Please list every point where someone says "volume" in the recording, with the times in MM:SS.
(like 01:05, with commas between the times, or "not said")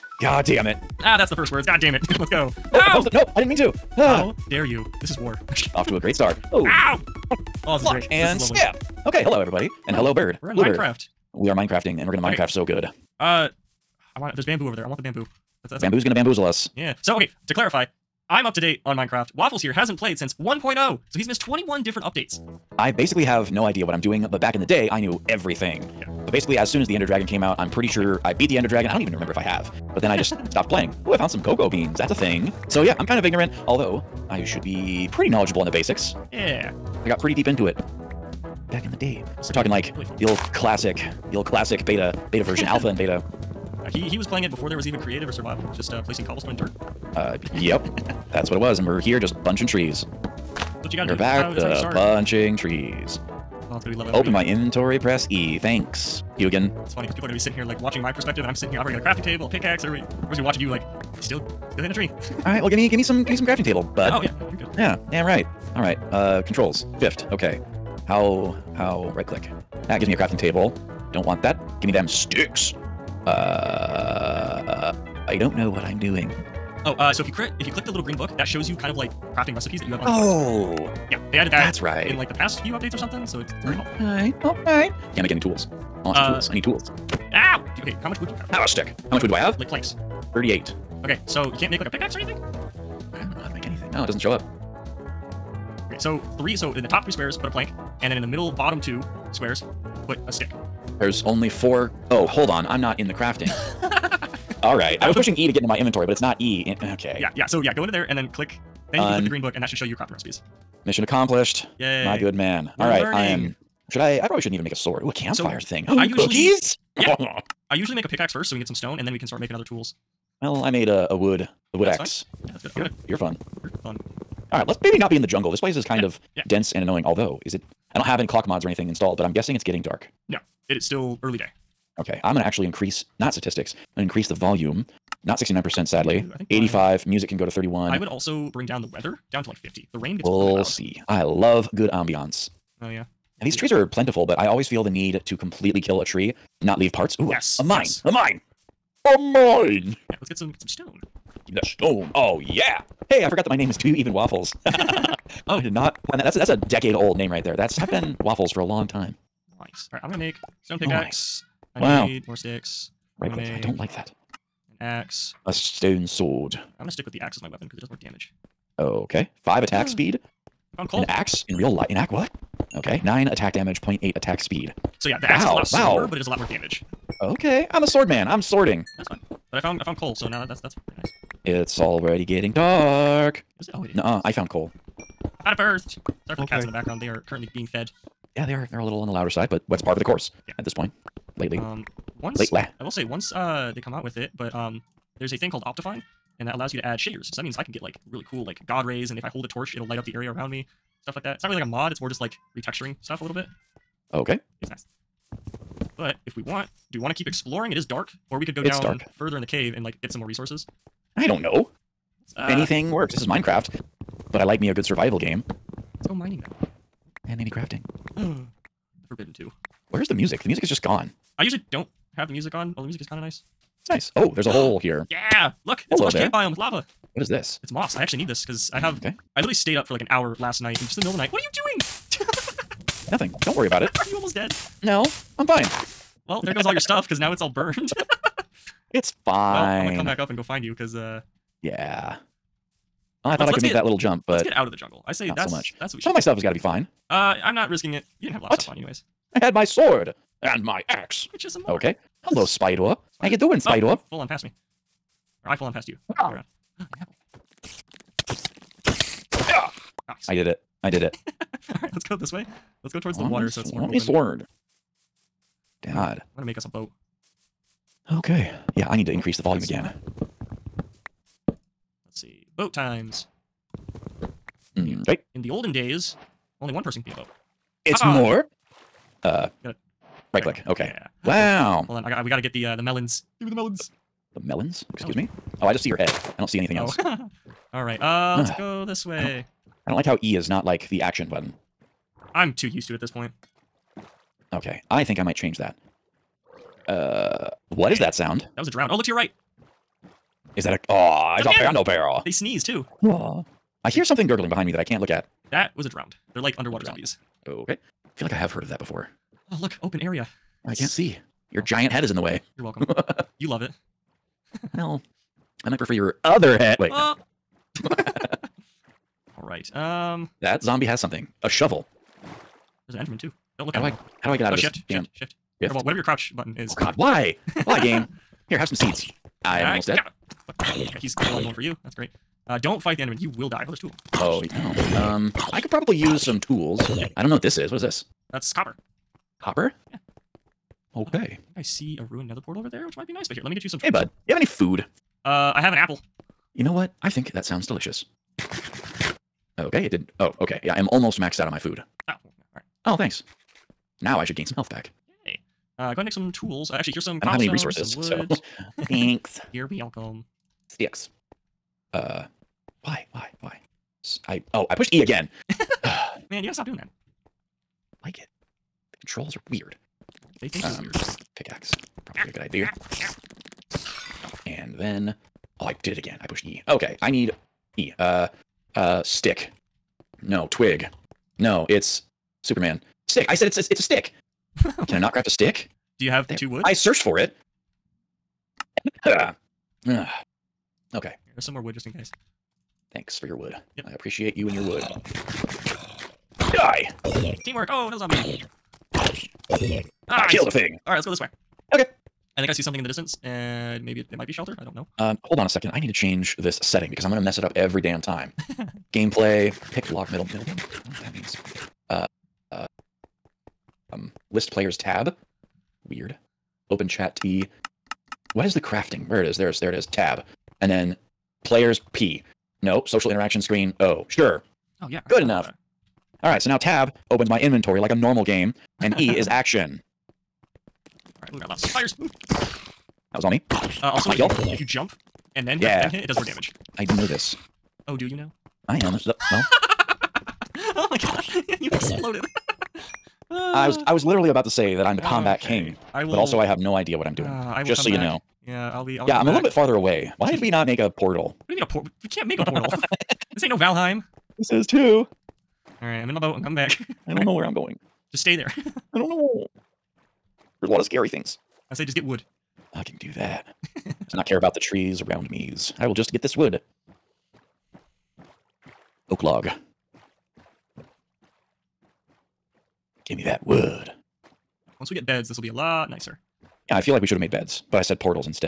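02:14, 04:29.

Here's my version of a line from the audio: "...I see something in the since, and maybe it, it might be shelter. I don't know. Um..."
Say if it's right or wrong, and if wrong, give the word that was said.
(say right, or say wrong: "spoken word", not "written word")
wrong: "distance", not "since".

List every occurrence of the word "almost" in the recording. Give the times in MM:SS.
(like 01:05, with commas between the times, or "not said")
03:54, 05:29, 05:50.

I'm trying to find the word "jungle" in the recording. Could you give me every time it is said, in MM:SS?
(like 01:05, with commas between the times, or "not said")
02:05, 04:04.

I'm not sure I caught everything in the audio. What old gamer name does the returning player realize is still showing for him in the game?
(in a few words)
Do You Even Waffles.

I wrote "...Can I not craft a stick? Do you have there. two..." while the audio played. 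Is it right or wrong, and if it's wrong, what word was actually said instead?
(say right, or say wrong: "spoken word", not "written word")
right.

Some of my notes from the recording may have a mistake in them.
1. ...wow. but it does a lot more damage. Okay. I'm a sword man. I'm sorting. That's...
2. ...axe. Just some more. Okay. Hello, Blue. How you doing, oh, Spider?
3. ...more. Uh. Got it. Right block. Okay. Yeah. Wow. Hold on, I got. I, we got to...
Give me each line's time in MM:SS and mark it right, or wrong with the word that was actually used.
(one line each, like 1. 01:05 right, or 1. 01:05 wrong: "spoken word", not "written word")
1. 02:56 right
2. 04:10 wrong: "Spider", not "Blue"
3. 04:38 wrong: "click", not "block".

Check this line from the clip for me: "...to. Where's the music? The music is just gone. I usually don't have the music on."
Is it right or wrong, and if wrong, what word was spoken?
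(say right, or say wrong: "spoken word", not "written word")
right.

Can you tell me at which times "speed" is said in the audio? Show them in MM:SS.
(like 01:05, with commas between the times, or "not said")
02:49, 02:54.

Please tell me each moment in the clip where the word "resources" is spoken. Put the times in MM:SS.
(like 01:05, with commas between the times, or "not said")
03:30, 05:57.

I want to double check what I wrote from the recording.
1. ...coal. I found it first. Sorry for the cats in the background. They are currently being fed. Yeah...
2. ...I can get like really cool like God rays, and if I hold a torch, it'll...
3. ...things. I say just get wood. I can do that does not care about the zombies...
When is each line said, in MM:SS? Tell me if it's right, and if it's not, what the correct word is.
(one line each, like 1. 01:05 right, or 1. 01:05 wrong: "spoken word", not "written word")
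1. 03:04 right
2. 03:17 right
3. 07:41 wrong: "trees", not "zombies".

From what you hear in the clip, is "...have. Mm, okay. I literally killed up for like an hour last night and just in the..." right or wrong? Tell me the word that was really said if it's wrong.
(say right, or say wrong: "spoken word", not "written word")
wrong: "stayed", not "killed".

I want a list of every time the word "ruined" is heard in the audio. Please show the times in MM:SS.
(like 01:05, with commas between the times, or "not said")
05:42.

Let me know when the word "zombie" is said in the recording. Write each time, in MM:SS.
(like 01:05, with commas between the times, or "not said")
05:06, 05:20, 06:37.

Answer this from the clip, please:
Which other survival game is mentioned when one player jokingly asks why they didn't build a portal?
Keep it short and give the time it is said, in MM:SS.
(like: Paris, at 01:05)
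Valheim, at 07:33.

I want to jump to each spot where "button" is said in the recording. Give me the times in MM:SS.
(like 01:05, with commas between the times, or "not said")
04:51, 05:26.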